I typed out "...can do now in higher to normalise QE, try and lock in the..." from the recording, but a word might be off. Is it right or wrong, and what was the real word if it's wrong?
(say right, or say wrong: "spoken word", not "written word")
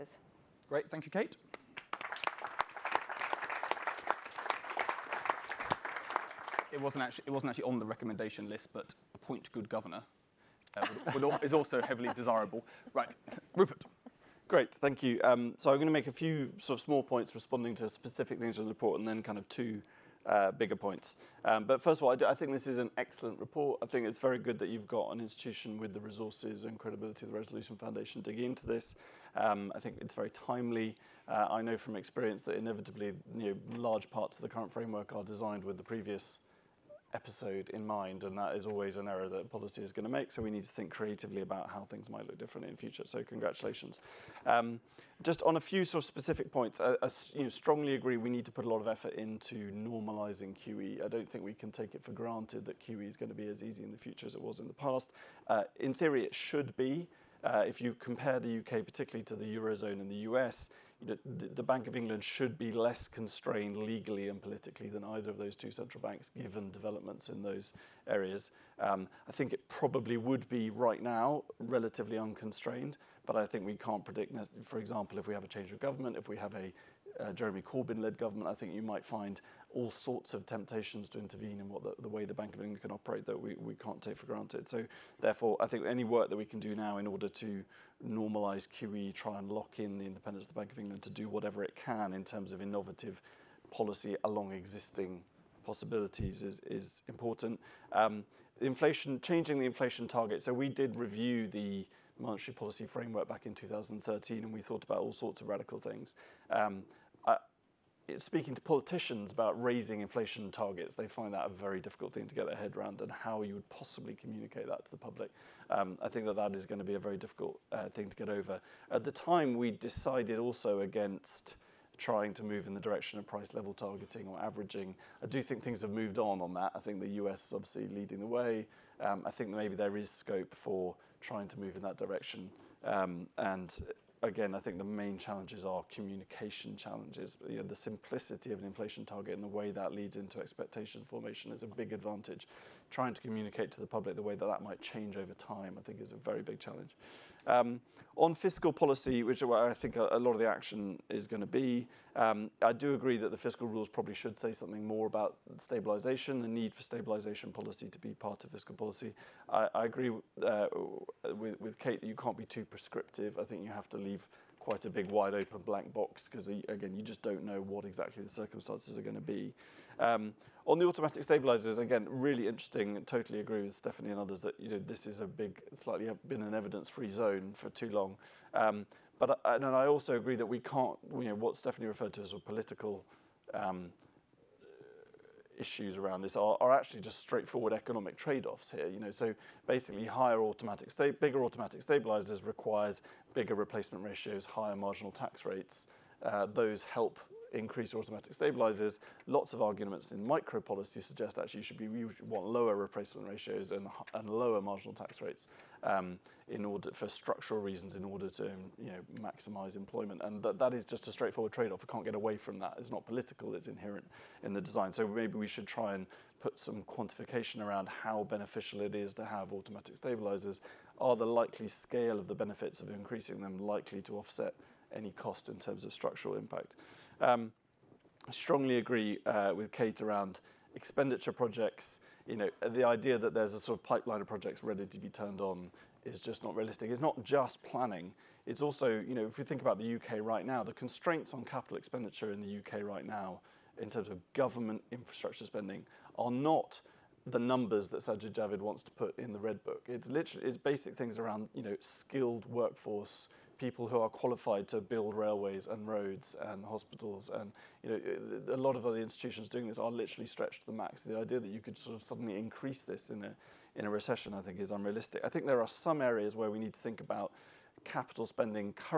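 wrong: "order", not "higher".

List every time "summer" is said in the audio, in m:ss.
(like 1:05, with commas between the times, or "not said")
not said.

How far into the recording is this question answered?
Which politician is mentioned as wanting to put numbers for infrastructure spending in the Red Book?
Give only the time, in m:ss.
4:07.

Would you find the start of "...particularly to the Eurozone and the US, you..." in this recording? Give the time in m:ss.
0:58.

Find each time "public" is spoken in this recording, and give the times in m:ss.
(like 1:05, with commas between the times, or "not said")
1:54, 2:23.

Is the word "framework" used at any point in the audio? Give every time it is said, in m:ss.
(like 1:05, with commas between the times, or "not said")
0:34, 1:42.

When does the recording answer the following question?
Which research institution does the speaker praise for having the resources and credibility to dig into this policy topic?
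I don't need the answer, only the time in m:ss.
0:27.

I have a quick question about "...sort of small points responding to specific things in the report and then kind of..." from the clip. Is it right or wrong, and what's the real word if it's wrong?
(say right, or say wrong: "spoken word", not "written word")
right.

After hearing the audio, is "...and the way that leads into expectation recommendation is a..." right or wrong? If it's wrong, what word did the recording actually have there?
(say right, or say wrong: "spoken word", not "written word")
wrong: "formation", not "recommendation".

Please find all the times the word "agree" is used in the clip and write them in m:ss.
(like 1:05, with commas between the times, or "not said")
0:47, 2:32, 2:39, 2:53, 3:00, 3:48.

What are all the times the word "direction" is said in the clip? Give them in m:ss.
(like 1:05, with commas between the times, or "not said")
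2:02, 2:11.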